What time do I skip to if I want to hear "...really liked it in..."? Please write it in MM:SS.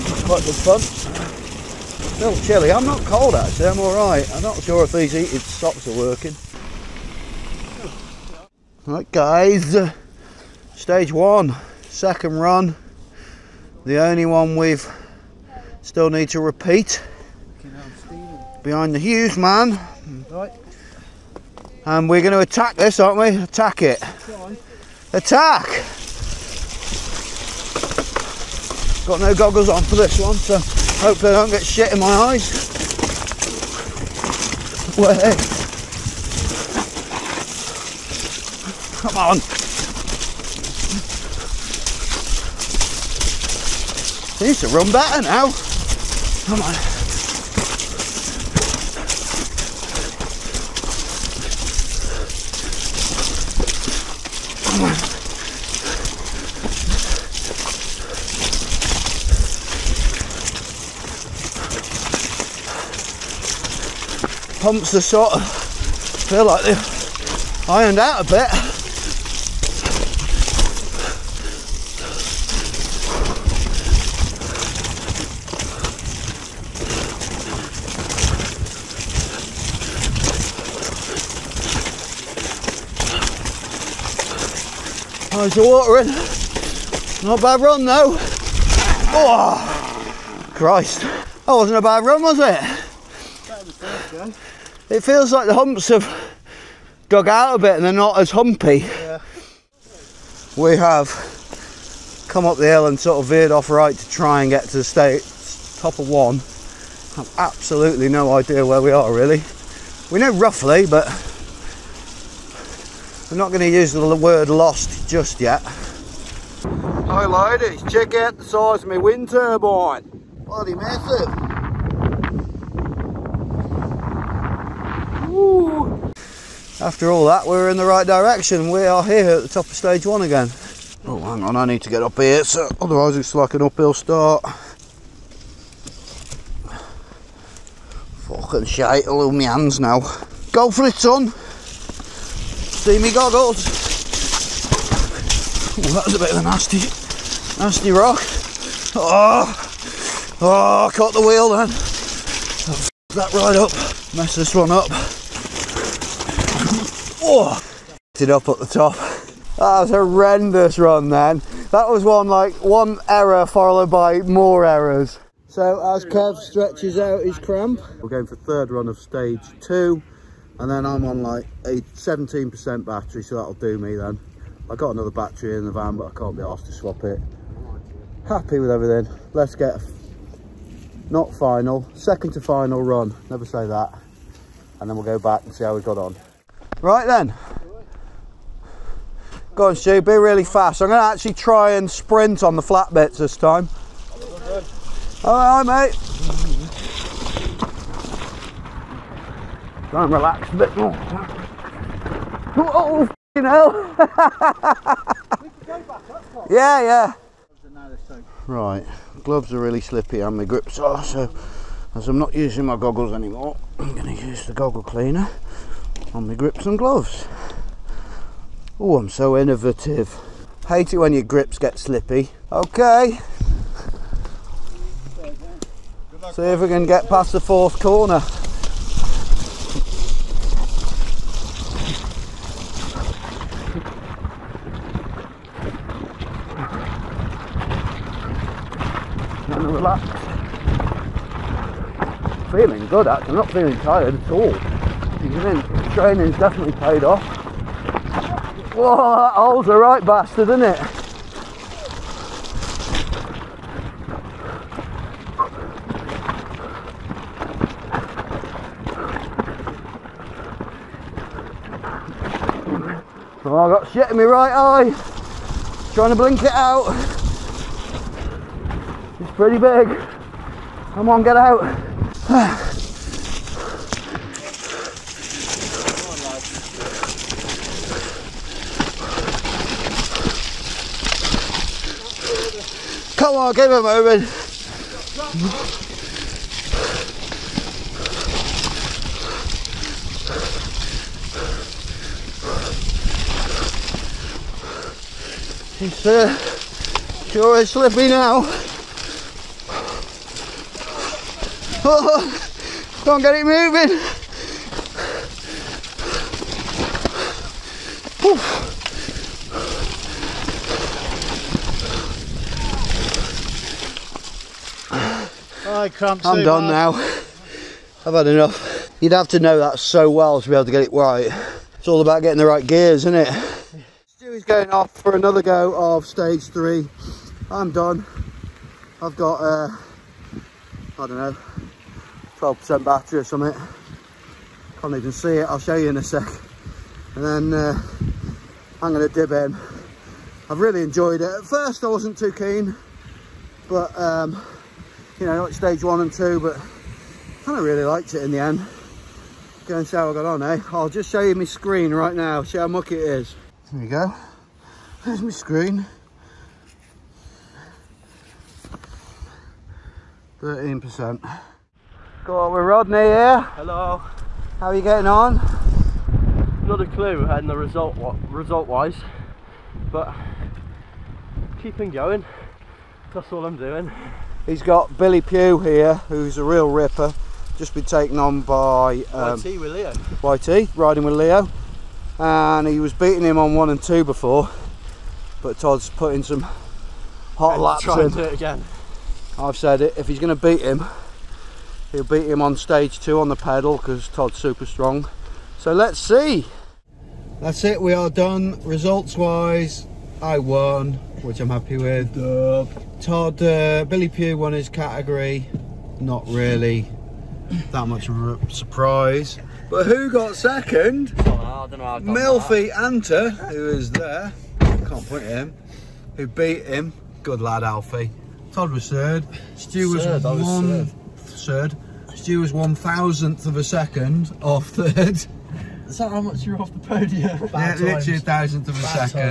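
05:47.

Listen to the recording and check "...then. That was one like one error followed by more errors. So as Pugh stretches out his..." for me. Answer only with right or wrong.
wrong.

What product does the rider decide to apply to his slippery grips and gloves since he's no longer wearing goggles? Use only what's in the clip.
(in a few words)
goggle cleaner.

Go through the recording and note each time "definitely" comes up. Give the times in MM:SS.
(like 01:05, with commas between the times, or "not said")
04:06.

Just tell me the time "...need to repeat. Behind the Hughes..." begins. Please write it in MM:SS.
00:16.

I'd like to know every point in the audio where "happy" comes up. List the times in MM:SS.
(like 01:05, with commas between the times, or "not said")
02:58, 06:41.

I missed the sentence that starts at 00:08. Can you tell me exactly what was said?
Right guys, stage one, second run.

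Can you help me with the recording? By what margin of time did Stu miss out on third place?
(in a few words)
one thousandth of a second.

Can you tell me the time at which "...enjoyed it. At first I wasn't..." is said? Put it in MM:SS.
05:40.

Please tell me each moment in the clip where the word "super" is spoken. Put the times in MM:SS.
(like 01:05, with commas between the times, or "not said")
06:34.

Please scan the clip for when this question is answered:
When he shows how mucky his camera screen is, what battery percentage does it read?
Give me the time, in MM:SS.
06:00.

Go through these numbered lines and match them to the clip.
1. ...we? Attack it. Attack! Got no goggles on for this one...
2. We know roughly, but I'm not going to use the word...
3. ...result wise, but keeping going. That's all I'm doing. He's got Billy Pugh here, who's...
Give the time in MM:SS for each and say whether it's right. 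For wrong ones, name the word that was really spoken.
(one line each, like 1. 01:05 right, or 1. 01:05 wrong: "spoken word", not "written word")
1. 00:23 right
2. 01:50 right
3. 06:08 right.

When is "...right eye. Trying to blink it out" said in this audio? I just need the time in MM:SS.
04:24.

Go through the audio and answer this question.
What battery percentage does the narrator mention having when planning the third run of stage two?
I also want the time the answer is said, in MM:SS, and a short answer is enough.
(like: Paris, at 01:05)
17%, at 02:51.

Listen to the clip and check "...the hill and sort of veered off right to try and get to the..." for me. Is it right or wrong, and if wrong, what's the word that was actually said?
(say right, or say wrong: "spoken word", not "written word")
right.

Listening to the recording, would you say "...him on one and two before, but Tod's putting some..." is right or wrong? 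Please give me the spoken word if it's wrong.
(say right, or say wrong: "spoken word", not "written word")
right.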